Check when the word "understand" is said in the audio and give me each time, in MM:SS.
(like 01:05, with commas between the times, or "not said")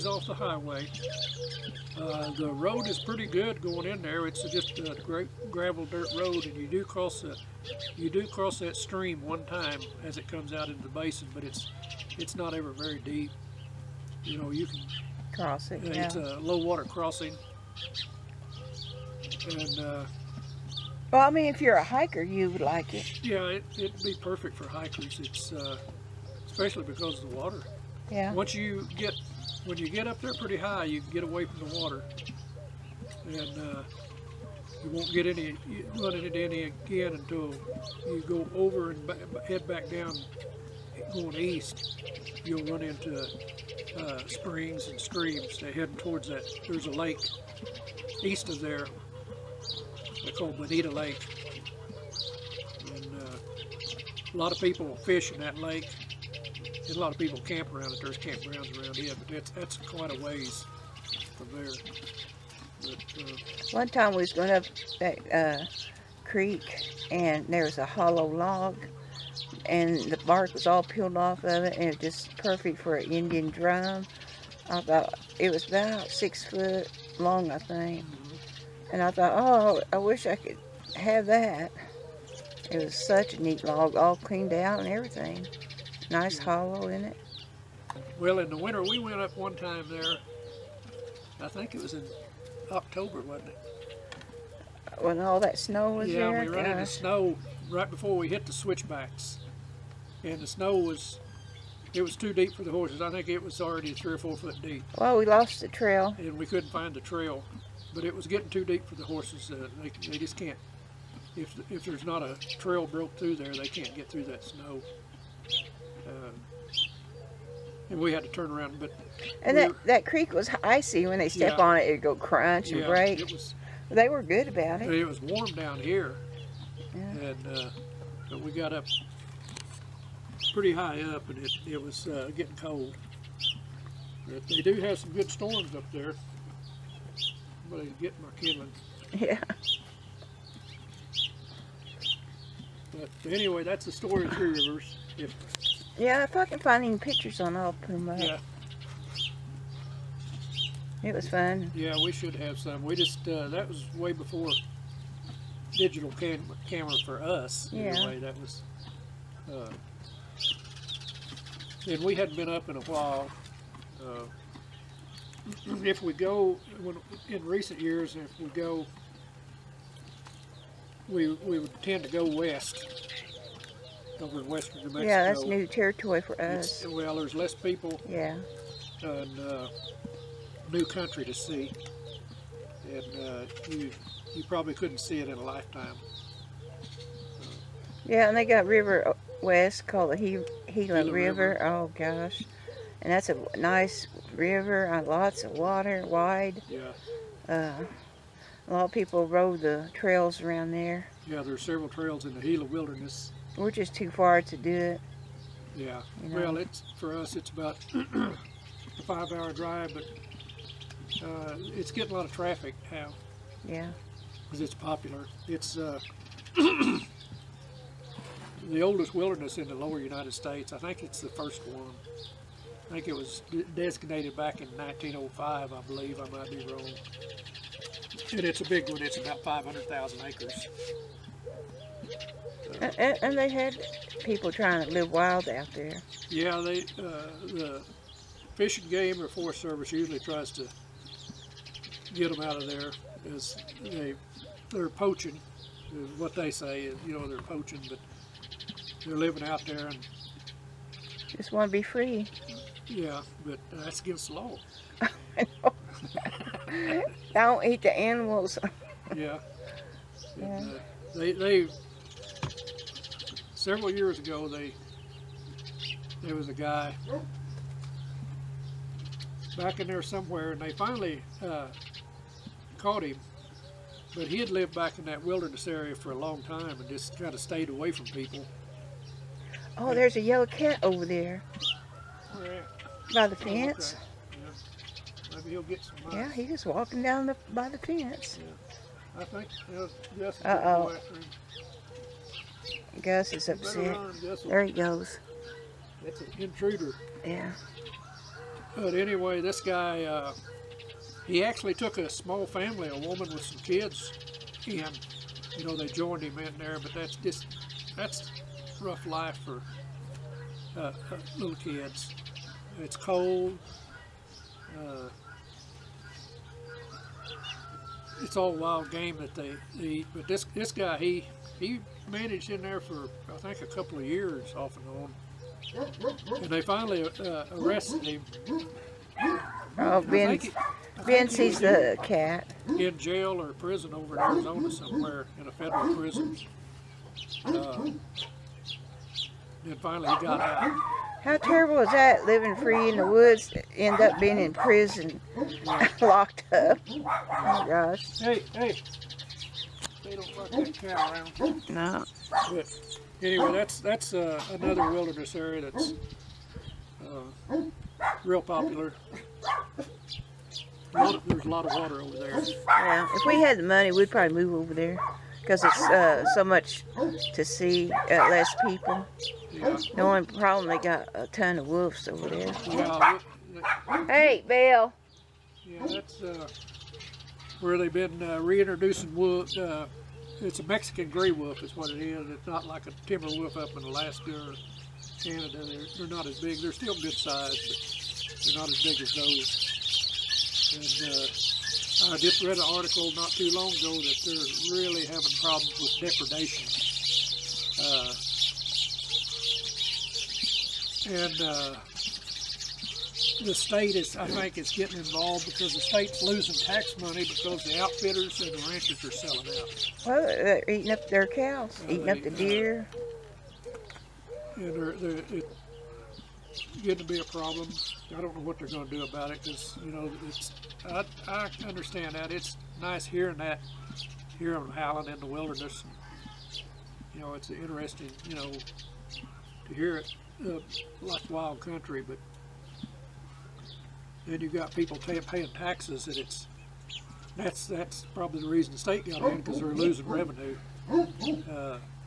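07:01.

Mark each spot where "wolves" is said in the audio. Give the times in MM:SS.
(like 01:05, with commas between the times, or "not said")
06:11, 06:19.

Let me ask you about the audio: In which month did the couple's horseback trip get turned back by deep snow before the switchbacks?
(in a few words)
October.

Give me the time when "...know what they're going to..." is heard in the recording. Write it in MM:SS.
06:58.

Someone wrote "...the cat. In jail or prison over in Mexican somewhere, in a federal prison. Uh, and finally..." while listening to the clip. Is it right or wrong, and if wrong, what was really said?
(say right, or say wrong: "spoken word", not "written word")
wrong: "Arizona", not "Mexican".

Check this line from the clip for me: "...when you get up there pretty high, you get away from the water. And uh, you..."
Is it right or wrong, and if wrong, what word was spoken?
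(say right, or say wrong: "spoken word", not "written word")
right.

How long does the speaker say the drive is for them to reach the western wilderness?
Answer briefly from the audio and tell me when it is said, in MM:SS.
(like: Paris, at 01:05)
5 hours, at 03:29.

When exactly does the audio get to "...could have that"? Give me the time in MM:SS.
01:20.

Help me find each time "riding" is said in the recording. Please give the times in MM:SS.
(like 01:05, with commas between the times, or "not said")
not said.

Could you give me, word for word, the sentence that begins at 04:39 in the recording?
Oh, and, there's a yellow cat over there.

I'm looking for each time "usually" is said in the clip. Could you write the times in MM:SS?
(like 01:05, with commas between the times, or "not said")
03:59.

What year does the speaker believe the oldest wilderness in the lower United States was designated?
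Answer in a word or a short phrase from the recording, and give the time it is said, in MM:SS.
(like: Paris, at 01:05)
1905, at 03:44.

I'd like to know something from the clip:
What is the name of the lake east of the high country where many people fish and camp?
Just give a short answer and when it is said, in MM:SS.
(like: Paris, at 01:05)
Bonita Lake, at 00:50.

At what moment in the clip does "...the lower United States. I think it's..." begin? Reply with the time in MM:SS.
03:39.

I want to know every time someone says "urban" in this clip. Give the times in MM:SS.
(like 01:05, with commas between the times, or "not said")
not said.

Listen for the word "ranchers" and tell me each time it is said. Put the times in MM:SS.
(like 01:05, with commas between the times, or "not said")
06:48.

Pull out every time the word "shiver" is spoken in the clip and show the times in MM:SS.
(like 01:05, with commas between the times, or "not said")
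not said.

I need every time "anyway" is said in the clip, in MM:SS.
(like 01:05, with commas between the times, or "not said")
02:23, 02:37, 04:58, 05:53.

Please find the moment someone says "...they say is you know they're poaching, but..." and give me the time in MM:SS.
04:06.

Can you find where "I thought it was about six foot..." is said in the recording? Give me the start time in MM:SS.
01:14.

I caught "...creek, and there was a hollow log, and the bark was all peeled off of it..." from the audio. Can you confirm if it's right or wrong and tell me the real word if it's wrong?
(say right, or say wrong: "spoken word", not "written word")
right.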